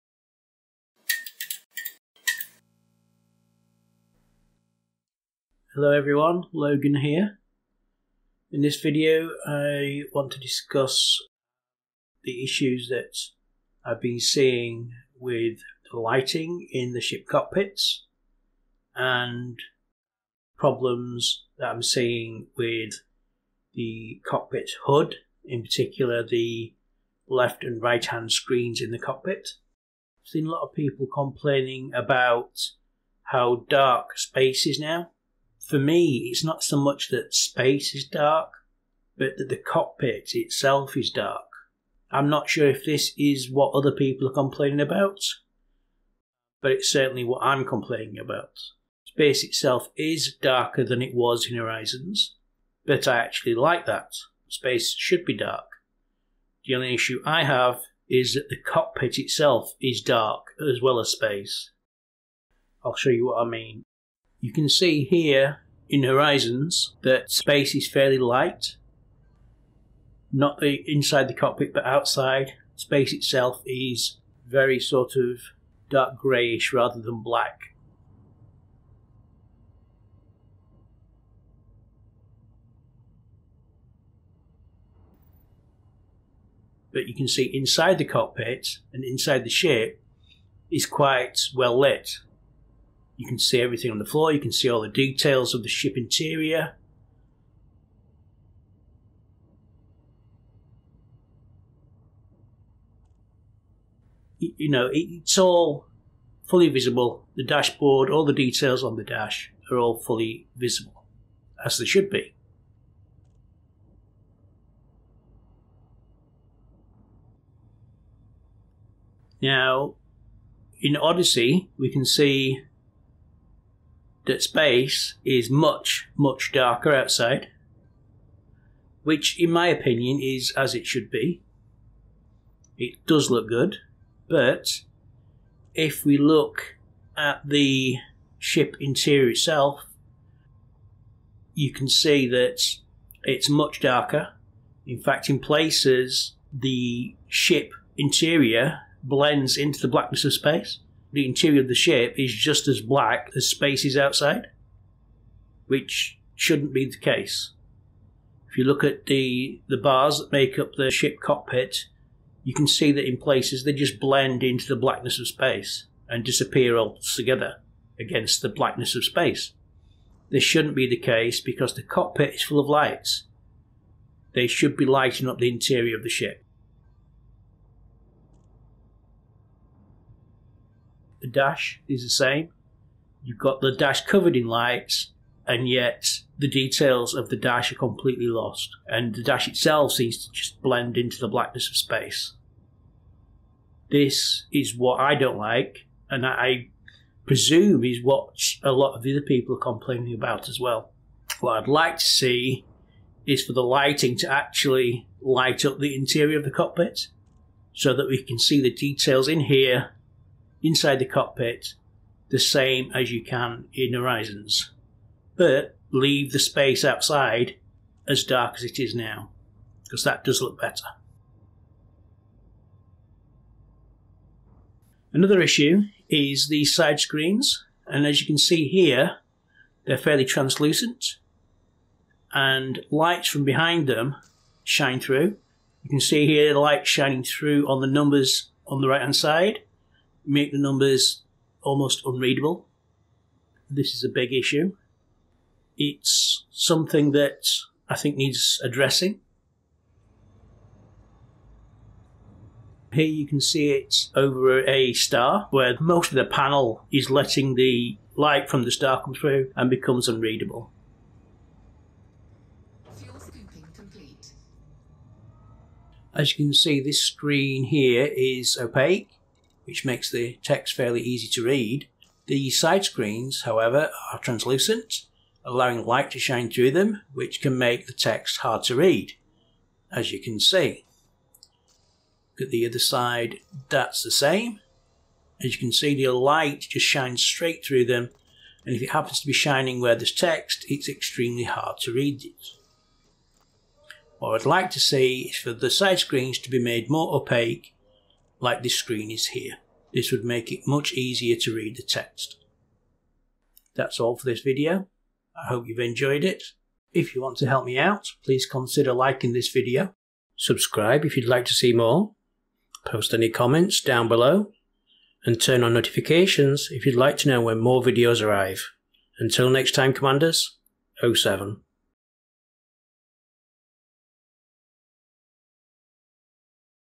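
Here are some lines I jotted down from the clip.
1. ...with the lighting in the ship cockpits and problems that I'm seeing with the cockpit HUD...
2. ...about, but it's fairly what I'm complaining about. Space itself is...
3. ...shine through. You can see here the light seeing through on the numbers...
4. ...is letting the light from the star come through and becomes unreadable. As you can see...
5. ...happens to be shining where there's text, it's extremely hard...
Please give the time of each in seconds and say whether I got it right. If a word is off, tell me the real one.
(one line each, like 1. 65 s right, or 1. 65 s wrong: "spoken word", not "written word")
1. 15 s right
2. 44 s wrong: "certainly", not "fairly"
3. 234 s wrong: "shining", not "seeing"
4. 256 s right
5. 288 s right.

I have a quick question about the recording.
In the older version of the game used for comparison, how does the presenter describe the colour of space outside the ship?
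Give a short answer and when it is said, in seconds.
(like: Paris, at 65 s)
dark greyish, at 75 s.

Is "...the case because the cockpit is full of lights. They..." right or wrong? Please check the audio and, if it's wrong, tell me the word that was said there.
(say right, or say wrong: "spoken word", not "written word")
right.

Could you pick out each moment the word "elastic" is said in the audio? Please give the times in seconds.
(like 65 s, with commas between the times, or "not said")
not said.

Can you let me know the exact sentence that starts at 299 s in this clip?
This would make it much easier to read the text.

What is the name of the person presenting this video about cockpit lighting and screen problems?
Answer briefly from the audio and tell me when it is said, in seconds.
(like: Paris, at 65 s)
Logan, at 6 s.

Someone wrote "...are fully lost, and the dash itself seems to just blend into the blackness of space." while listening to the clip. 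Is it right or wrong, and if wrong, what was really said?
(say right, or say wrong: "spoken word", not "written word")
wrong: "completely", not "fully".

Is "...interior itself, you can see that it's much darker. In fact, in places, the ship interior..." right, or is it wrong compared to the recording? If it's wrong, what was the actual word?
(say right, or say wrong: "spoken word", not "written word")
right.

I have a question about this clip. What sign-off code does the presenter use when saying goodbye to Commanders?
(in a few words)
07.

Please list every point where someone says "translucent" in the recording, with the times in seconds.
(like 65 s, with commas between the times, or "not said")
230 s, 274 s.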